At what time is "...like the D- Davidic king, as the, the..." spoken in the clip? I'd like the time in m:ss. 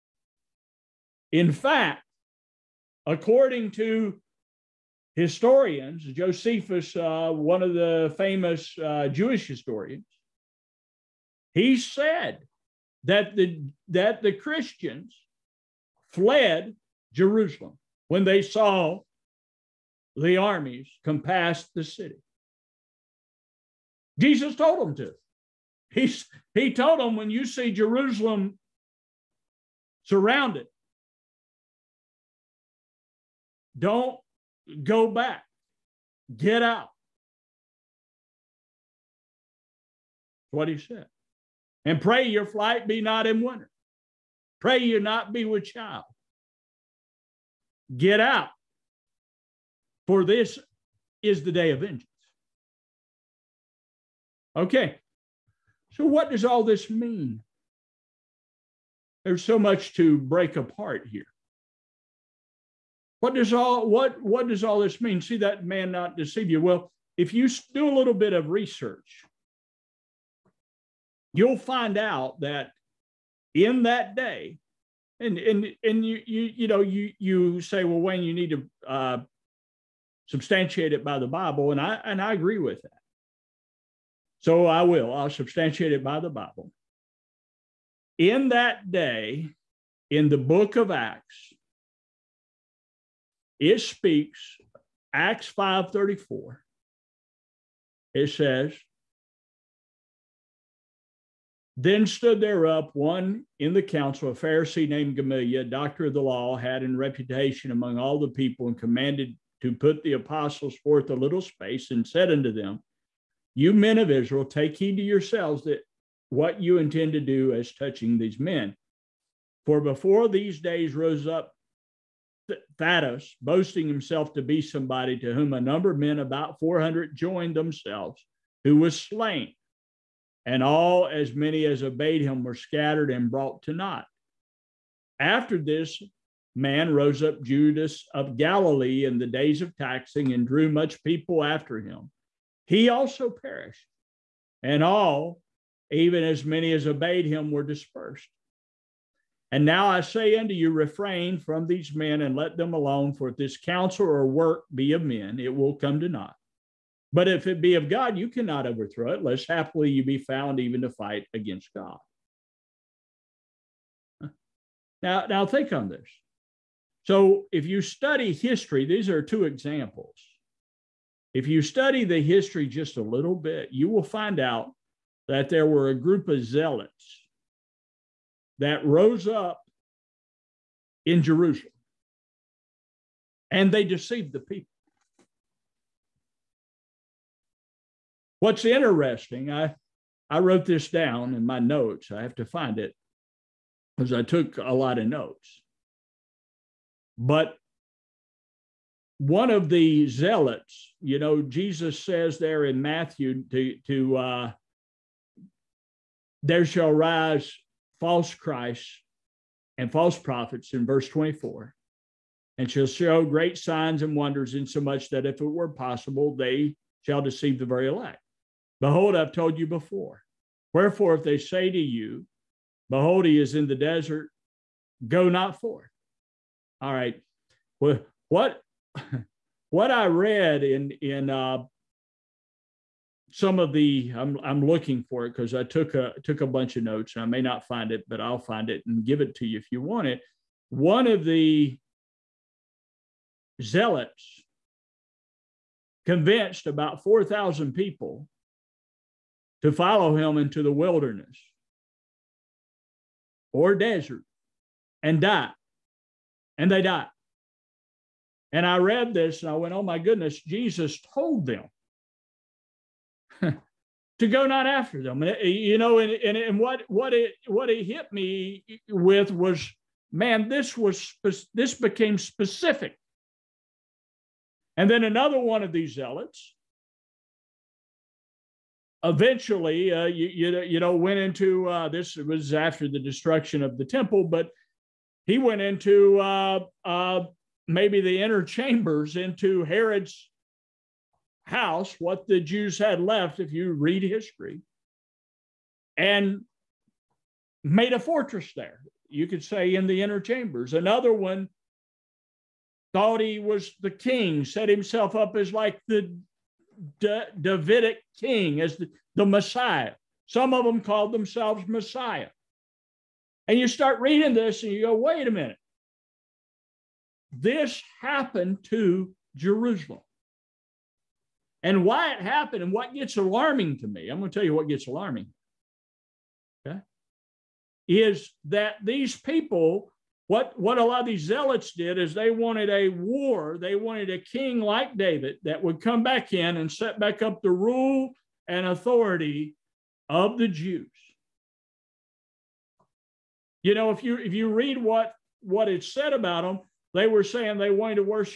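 5:05.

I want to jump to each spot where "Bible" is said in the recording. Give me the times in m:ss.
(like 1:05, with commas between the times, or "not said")
1:21, 1:26.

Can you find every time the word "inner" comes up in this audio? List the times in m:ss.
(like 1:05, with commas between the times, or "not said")
4:48, 5:00.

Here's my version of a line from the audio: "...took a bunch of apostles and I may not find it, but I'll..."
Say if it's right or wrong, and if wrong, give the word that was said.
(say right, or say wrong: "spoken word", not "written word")
wrong: "notes", not "apostles".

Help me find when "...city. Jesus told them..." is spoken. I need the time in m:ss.
0:21.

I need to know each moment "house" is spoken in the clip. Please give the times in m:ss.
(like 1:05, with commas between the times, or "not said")
4:51.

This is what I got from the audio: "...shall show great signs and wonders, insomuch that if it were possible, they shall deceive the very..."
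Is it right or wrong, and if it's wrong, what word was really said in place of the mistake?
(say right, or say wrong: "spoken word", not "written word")
right.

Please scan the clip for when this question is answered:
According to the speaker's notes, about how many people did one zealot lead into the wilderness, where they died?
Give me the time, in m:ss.
4:07.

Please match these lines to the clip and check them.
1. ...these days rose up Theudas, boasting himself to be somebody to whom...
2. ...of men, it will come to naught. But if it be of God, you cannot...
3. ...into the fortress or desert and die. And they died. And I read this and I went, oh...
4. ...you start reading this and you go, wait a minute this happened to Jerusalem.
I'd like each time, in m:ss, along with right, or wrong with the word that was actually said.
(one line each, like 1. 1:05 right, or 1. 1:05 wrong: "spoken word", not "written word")
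1. 2:00 right
2. 2:34 right
3. 4:10 wrong: "wilderness", not "fortress"
4. 5:13 right.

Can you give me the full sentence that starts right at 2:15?
After this man rose up Judas of Galilee in the days of taxing and drew much people after him he also perished.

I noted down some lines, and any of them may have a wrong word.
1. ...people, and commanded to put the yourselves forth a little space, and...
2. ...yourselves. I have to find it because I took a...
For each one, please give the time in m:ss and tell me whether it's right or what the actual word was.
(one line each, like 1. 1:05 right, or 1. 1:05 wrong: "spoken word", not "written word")
1. 1:48 wrong: "apostles", not "yourselves"
2. 3:11 wrong: "notes", not "yourselves".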